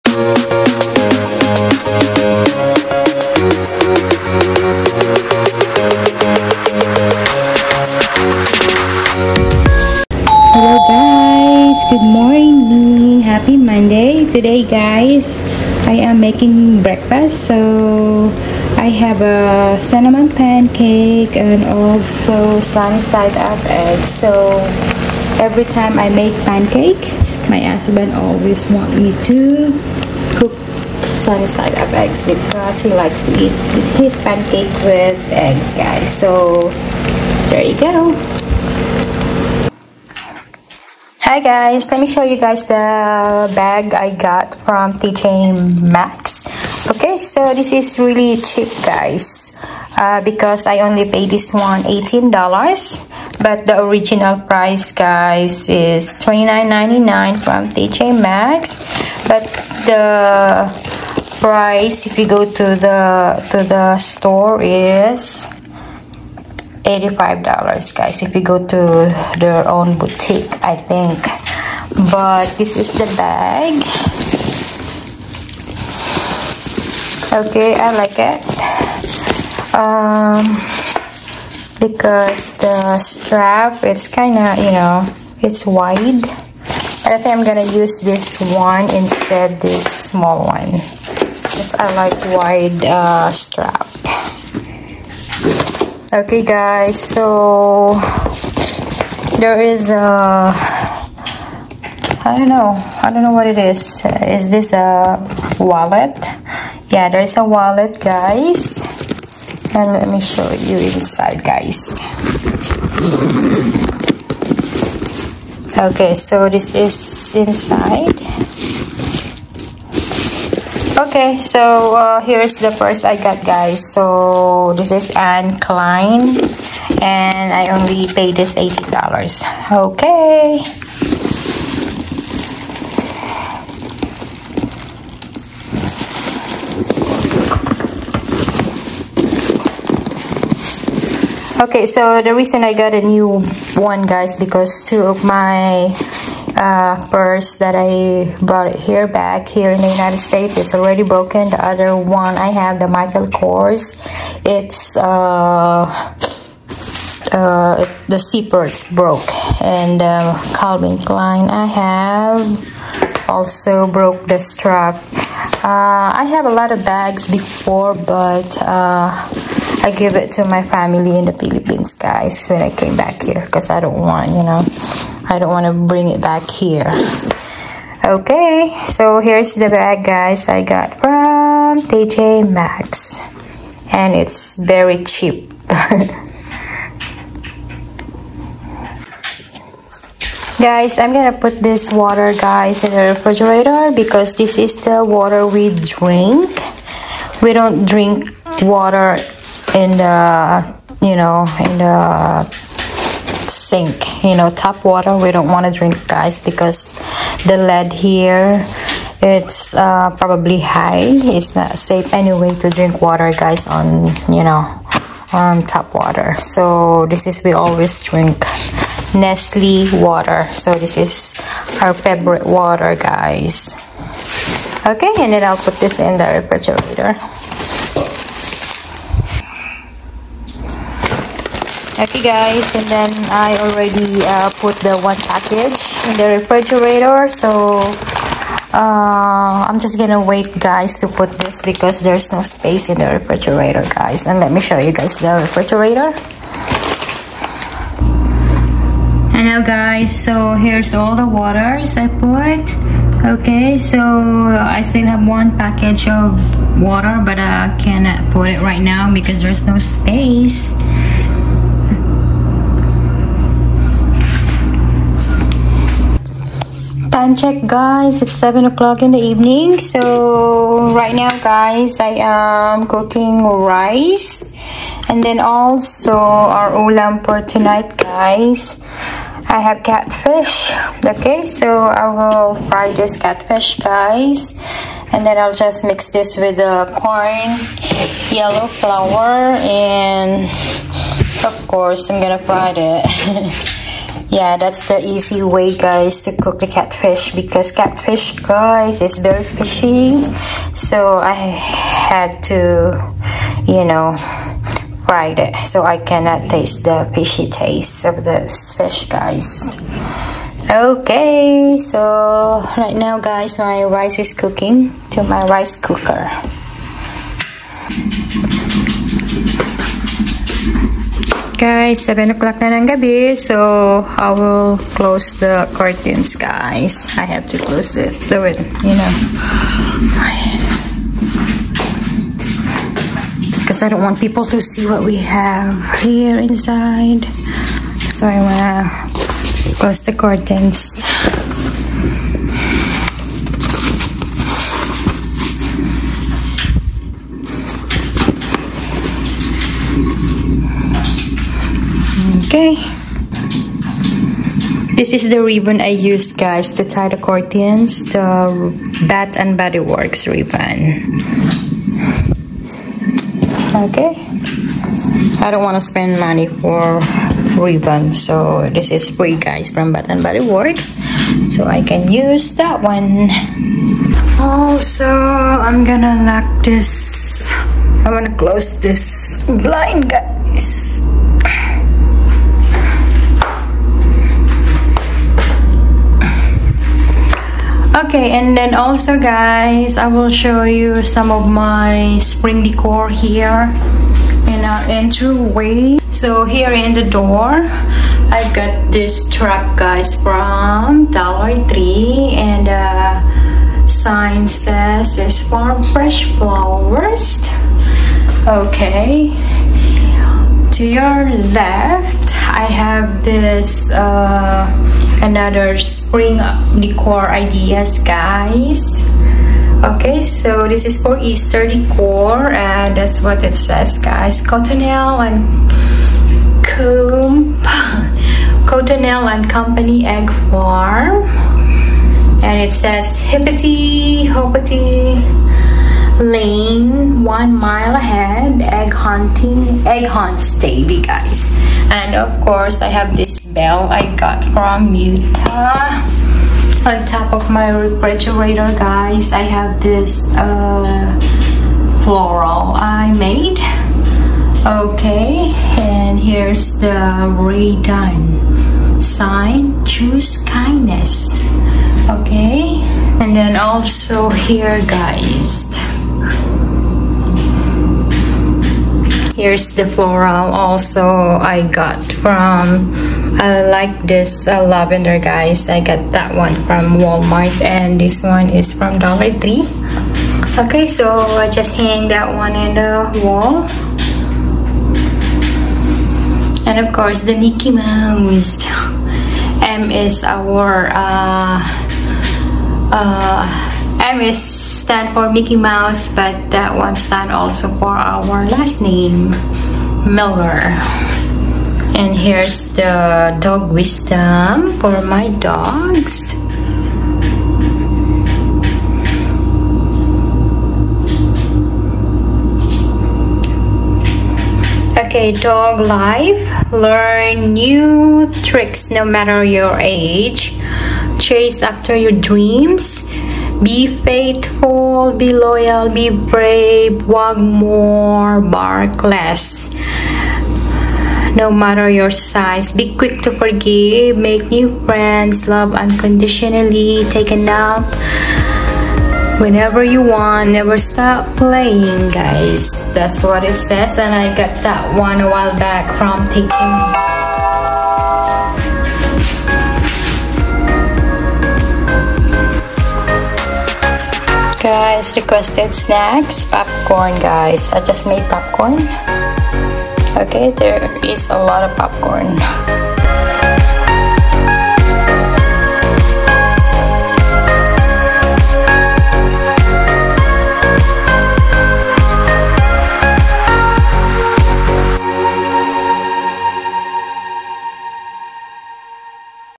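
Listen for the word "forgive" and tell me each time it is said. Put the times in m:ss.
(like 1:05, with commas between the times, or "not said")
8:53.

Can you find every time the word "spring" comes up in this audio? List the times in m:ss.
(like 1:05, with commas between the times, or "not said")
6:32, 6:55.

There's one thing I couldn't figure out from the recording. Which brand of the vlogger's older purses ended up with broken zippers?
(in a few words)
Michael Kors.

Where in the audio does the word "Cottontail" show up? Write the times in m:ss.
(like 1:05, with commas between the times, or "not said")
7:04, 7:08.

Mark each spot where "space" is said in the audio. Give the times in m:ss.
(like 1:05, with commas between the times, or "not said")
4:02, 4:19.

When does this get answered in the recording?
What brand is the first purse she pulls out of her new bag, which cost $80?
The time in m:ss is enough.
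2:05.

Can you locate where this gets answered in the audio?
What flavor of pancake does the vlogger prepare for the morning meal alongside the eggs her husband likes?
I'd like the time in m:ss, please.
0:19.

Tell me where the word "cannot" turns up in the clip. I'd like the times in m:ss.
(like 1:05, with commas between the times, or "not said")
4:17, 5:05.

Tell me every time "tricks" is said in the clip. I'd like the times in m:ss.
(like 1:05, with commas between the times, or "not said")
8:38.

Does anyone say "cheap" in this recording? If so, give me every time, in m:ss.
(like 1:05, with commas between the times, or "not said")
0:48, 3:05.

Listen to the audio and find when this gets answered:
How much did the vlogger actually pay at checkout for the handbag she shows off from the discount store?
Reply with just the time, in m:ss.
0:51.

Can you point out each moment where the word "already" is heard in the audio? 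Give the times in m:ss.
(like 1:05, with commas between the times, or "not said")
2:30, 3:53.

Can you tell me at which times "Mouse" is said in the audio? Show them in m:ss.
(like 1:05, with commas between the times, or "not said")
8:07, 8:15.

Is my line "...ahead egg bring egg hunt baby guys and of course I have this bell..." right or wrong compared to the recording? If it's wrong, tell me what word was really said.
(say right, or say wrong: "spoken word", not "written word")
wrong: "hunting", not "bring".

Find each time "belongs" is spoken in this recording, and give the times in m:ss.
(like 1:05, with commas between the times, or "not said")
not said.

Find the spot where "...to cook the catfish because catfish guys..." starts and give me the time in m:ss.
4:56.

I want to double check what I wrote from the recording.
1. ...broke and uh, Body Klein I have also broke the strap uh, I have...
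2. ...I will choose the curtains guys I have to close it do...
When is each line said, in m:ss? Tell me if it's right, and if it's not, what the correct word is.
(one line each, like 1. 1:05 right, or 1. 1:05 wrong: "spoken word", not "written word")
1. 2:38 wrong: "Calvin", not "Body"
2. 5:24 wrong: "close", not "choose".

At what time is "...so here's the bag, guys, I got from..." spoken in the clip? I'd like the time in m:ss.
2:58.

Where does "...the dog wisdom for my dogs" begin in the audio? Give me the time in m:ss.
8:22.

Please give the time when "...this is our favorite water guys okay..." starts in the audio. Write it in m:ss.
3:40.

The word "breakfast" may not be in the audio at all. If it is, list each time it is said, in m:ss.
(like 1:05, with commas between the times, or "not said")
0:16.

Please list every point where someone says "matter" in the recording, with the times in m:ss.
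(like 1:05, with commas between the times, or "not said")
8:39, 8:51.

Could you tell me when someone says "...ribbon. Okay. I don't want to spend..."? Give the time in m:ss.
6:00.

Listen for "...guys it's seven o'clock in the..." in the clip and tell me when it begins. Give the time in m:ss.
4:27.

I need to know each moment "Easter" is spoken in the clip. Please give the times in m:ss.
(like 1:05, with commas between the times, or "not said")
7:01.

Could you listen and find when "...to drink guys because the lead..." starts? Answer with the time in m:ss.
3:25.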